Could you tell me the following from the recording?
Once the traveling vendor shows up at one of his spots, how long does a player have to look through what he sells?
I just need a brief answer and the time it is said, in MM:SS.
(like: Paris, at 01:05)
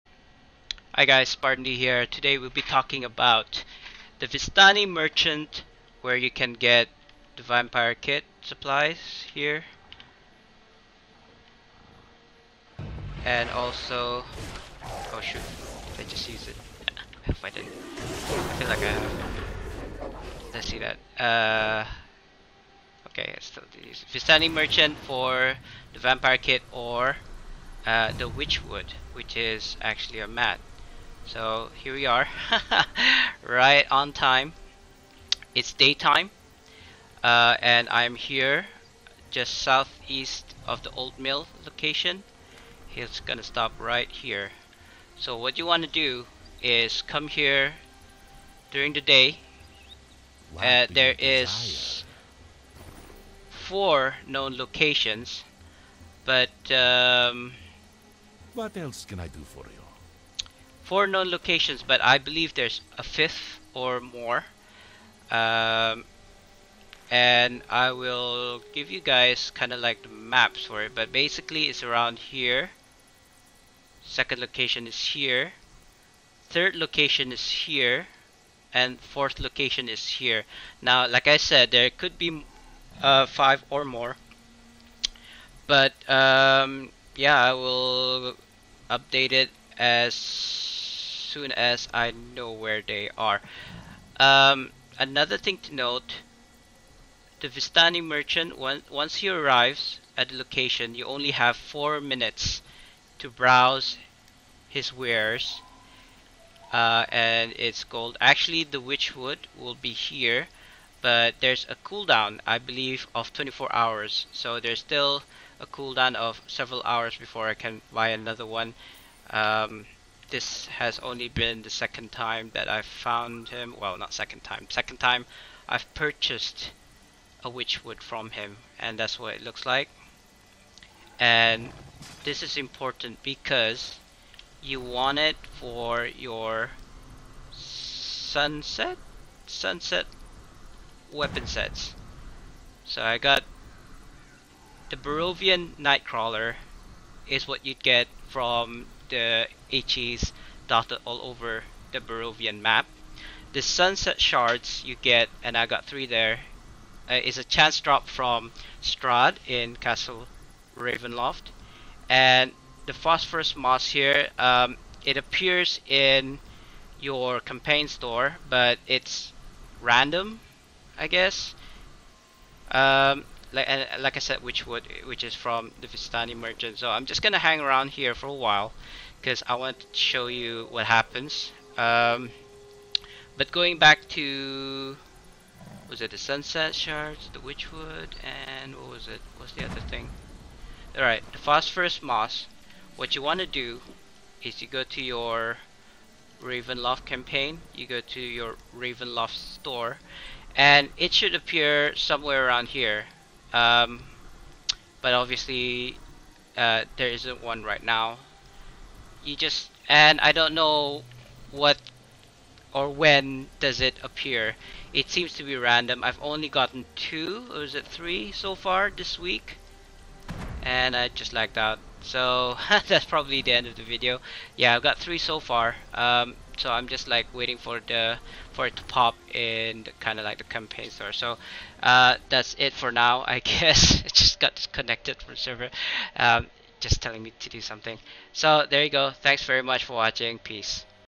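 4 minutes, at 01:41.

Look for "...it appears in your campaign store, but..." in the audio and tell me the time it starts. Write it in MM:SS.
02:45.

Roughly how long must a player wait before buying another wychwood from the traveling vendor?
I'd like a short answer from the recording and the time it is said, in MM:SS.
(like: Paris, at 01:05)
24 hours, at 01:53.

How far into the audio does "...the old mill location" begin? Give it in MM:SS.
00:40.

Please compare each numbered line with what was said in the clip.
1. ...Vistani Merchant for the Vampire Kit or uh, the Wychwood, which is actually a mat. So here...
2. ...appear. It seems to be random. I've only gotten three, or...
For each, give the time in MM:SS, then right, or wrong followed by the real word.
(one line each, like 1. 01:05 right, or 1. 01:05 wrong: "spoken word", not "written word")
1. 00:24 right
2. 03:34 wrong: "two", not "three".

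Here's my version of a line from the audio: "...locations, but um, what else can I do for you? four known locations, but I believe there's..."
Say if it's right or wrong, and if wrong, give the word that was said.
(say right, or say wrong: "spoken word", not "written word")
right.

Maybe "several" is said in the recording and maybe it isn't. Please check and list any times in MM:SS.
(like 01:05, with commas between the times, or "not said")
01:56.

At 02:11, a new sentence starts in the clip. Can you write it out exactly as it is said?
And this is important because you want it for your sunset?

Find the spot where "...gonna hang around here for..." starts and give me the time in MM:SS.
02:57.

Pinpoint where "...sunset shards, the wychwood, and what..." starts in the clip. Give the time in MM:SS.
03:06.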